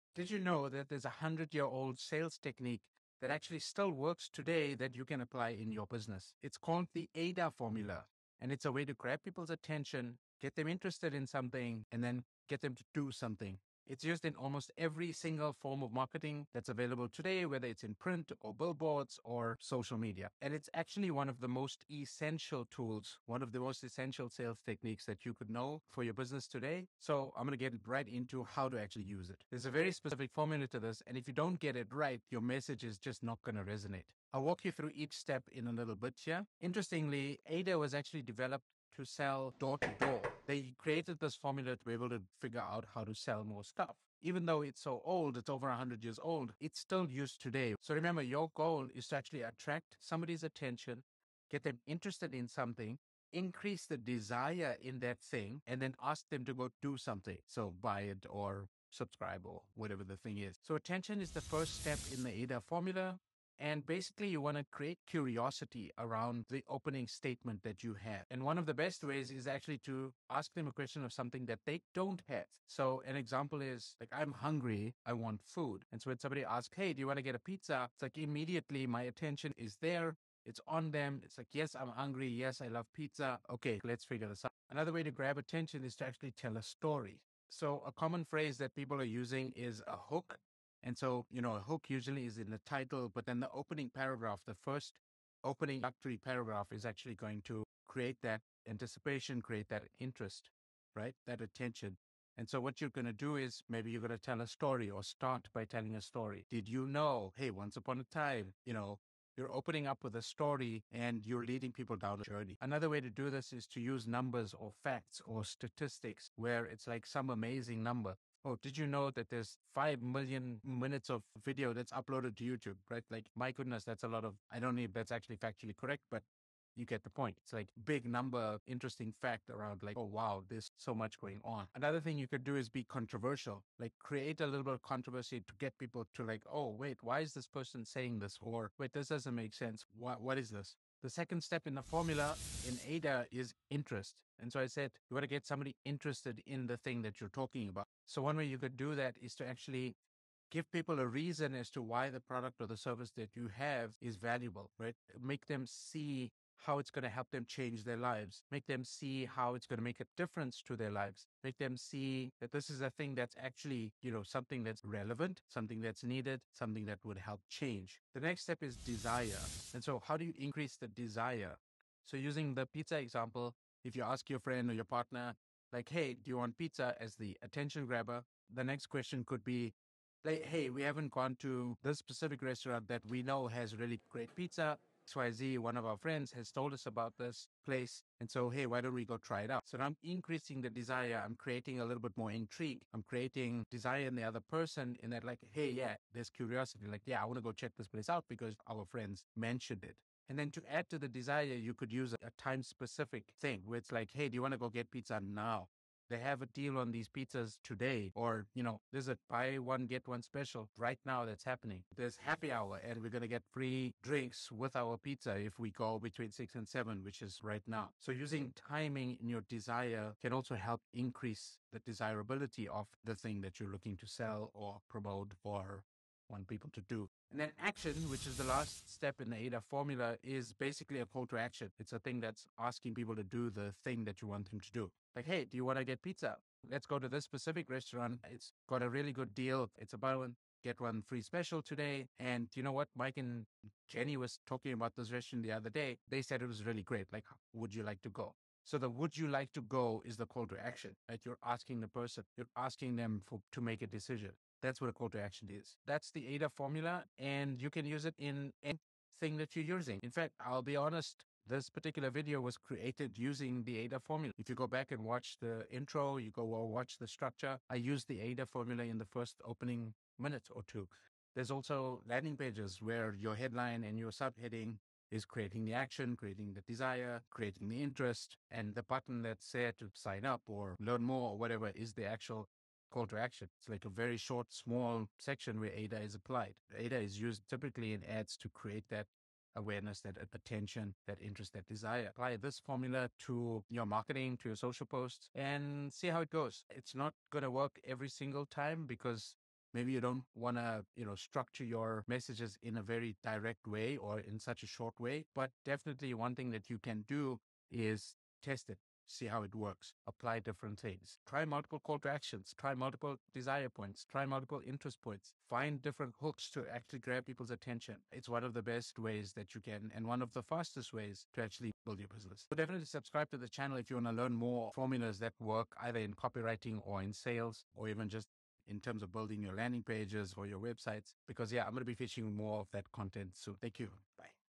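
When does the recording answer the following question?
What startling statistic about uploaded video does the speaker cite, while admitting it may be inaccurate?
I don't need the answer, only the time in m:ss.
1:59.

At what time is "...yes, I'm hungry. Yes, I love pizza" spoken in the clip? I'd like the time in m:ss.
1:21.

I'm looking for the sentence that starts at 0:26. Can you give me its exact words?
So I'm going to get right into how to actually use it.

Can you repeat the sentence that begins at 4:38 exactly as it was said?
And the button that's there to sign up or learn more or whatever is the actual call to action.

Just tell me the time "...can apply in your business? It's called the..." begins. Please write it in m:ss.
0:05.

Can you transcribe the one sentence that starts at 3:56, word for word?
Let's go to this specific restaurant.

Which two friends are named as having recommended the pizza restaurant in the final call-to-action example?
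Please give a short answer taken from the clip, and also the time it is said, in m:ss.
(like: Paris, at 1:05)
Mike and Jenny, at 4:02.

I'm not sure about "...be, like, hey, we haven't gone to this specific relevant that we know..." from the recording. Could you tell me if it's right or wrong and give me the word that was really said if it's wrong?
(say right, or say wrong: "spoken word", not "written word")
wrong: "restaurant", not "relevant".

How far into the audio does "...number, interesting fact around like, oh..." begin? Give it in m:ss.
2:08.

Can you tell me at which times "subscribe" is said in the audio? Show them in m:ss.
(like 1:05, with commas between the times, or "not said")
0:58, 5:22.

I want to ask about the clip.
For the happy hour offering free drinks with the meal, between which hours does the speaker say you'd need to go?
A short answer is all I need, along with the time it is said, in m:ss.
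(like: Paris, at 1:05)
6 and 7, at 3:36.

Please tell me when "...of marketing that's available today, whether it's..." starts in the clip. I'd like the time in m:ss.
0:15.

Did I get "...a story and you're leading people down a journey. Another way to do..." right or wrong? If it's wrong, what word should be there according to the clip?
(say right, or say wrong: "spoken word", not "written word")
right.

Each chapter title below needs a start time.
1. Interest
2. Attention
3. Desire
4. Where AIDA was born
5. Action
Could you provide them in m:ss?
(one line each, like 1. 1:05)
1. 2:20
2. 1:00
3. 2:48
4. 0:36
5. 3:47.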